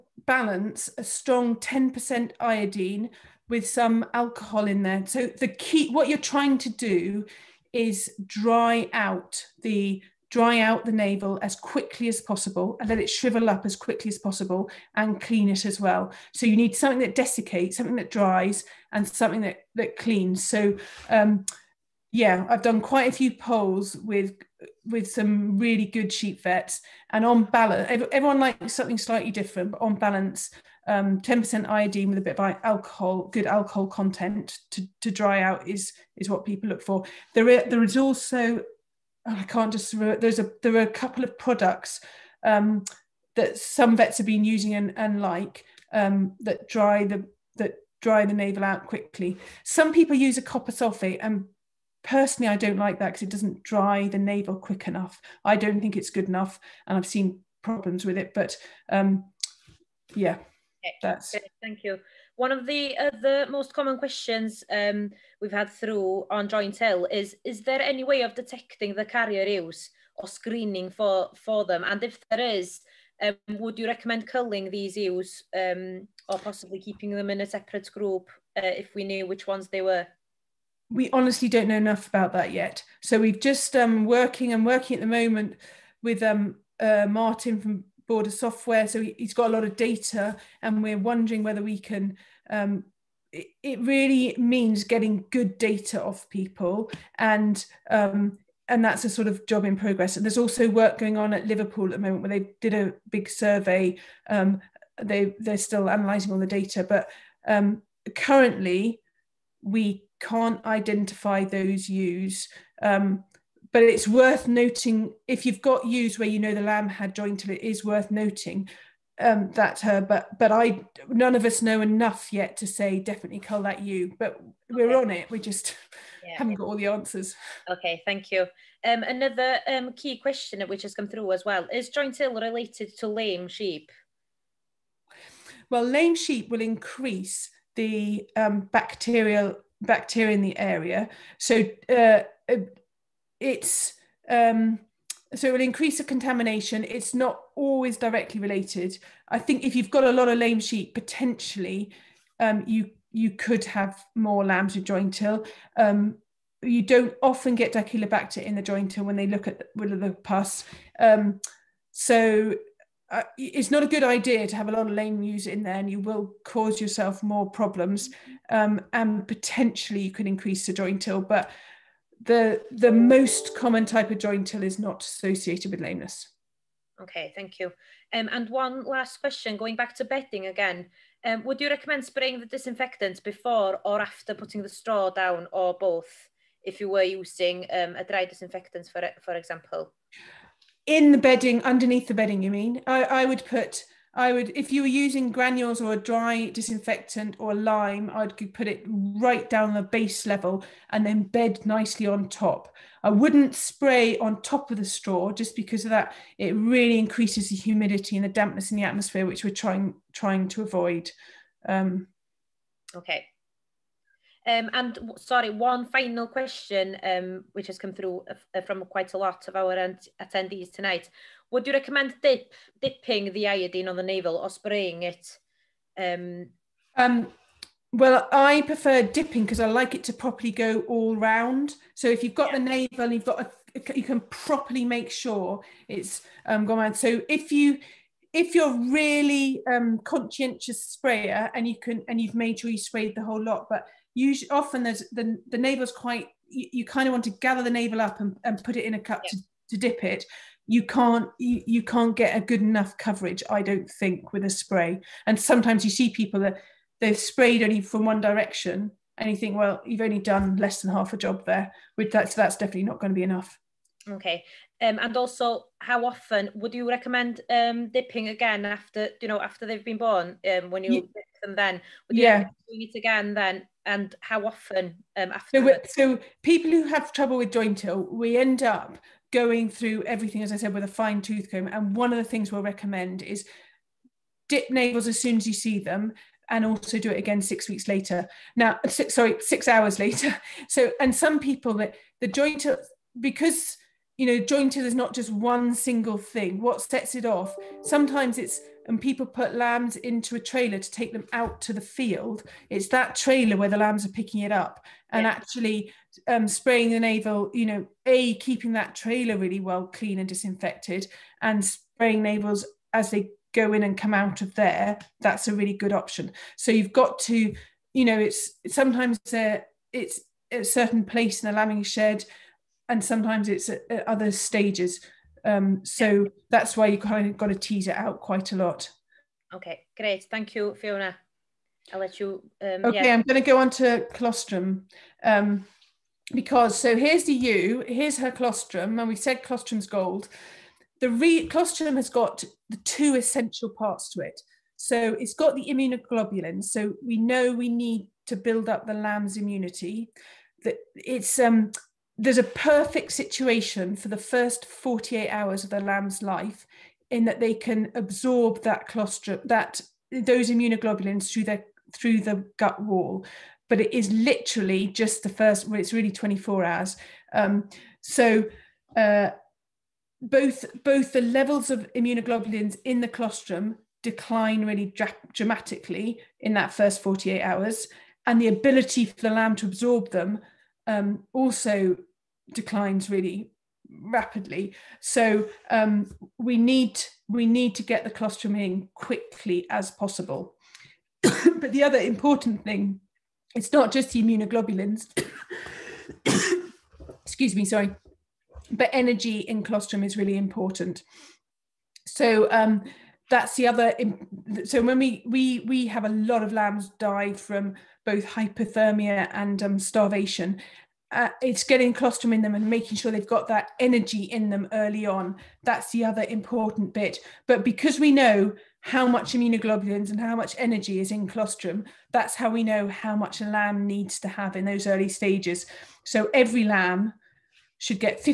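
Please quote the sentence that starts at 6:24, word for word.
So um, we need we need to get the colostrum in quickly as possible.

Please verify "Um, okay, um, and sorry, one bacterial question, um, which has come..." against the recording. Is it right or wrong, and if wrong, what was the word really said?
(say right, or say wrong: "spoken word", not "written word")
wrong: "final", not "bacterial".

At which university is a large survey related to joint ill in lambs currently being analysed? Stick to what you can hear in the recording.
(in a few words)
Liverpool.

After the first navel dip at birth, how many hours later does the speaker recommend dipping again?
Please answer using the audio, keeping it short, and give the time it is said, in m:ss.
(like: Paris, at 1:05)
6 hours, at 4:49.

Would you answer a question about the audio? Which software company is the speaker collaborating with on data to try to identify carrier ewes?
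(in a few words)
Border Software.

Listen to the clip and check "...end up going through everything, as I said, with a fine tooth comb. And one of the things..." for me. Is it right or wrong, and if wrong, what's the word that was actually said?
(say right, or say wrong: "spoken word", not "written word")
right.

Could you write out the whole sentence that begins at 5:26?
that's why you kind of got to tease it out quite a lot.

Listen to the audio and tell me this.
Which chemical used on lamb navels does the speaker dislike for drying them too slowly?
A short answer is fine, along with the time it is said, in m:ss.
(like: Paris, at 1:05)
copper sulfate, at 0:50.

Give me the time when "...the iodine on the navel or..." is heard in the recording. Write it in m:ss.
3:43.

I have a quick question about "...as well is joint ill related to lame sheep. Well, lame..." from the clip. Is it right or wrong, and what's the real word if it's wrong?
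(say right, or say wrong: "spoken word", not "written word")
right.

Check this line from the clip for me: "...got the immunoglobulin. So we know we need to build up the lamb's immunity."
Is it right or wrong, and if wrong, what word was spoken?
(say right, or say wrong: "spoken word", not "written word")
right.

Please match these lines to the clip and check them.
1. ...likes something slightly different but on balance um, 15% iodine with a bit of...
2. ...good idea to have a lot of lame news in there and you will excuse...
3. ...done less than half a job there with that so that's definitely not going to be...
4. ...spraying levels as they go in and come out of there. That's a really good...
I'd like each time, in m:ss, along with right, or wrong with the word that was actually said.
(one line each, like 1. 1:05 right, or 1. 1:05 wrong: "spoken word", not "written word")
1. 0:28 wrong: "10", not "15"
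2. 2:43 wrong: "cause", not "excuse"
3. 4:20 right
4. 5:11 wrong: "navels", not "levels".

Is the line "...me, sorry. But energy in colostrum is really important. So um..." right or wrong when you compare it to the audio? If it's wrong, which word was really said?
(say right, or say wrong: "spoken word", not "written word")
right.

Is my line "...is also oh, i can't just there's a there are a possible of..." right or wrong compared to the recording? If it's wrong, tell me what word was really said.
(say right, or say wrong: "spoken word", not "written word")
wrong: "couple", not "possible".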